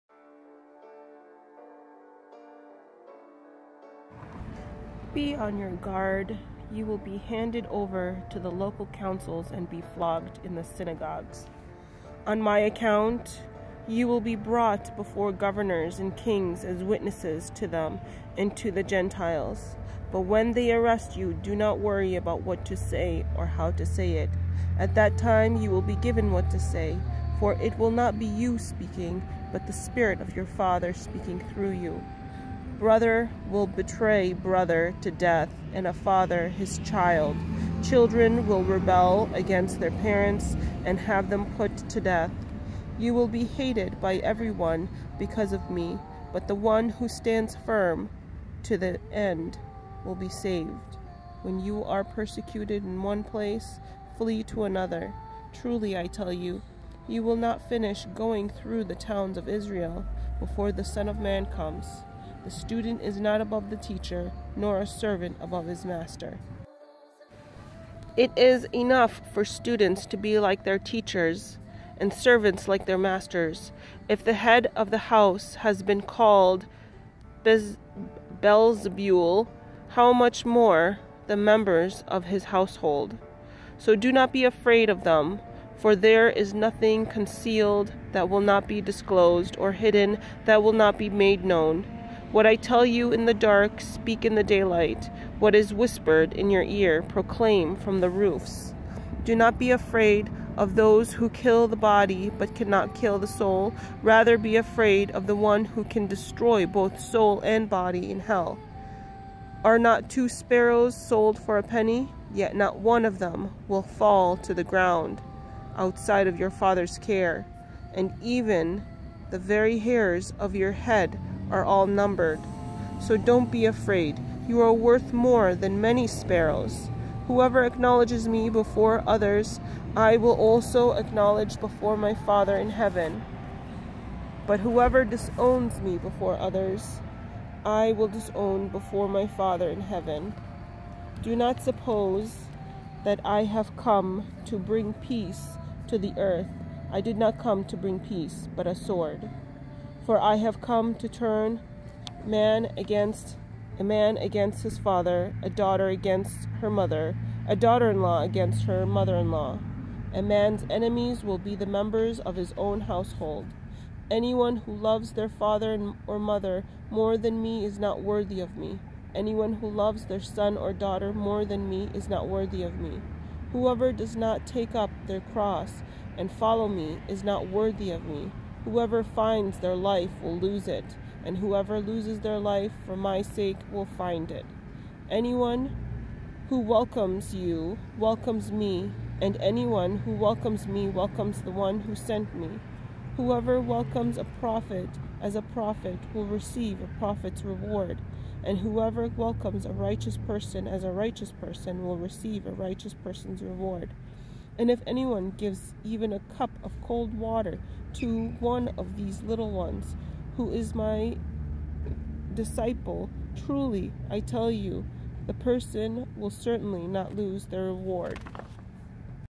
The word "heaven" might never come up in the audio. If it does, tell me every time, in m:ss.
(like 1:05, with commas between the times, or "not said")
2:12, 2:19.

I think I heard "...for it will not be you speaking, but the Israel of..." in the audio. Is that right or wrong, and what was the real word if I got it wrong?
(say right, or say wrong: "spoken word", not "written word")
wrong: "Spirit", not "Israel".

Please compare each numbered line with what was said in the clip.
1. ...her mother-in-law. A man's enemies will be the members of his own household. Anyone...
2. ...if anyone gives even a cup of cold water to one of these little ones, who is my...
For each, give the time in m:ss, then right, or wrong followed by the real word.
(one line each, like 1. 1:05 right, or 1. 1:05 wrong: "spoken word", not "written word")
1. 2:38 right
2. 3:24 right.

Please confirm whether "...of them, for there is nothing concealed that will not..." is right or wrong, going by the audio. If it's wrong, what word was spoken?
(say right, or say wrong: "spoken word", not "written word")
right.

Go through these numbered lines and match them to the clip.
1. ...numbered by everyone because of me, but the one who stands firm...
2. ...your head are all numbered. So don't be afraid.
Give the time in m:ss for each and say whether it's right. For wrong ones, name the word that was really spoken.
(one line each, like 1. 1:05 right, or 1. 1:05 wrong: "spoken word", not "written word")
1. 0:43 wrong: "hated", not "numbered"
2. 2:00 right.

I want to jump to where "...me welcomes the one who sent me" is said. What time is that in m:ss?
3:10.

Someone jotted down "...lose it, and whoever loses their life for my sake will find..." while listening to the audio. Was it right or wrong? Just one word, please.
right.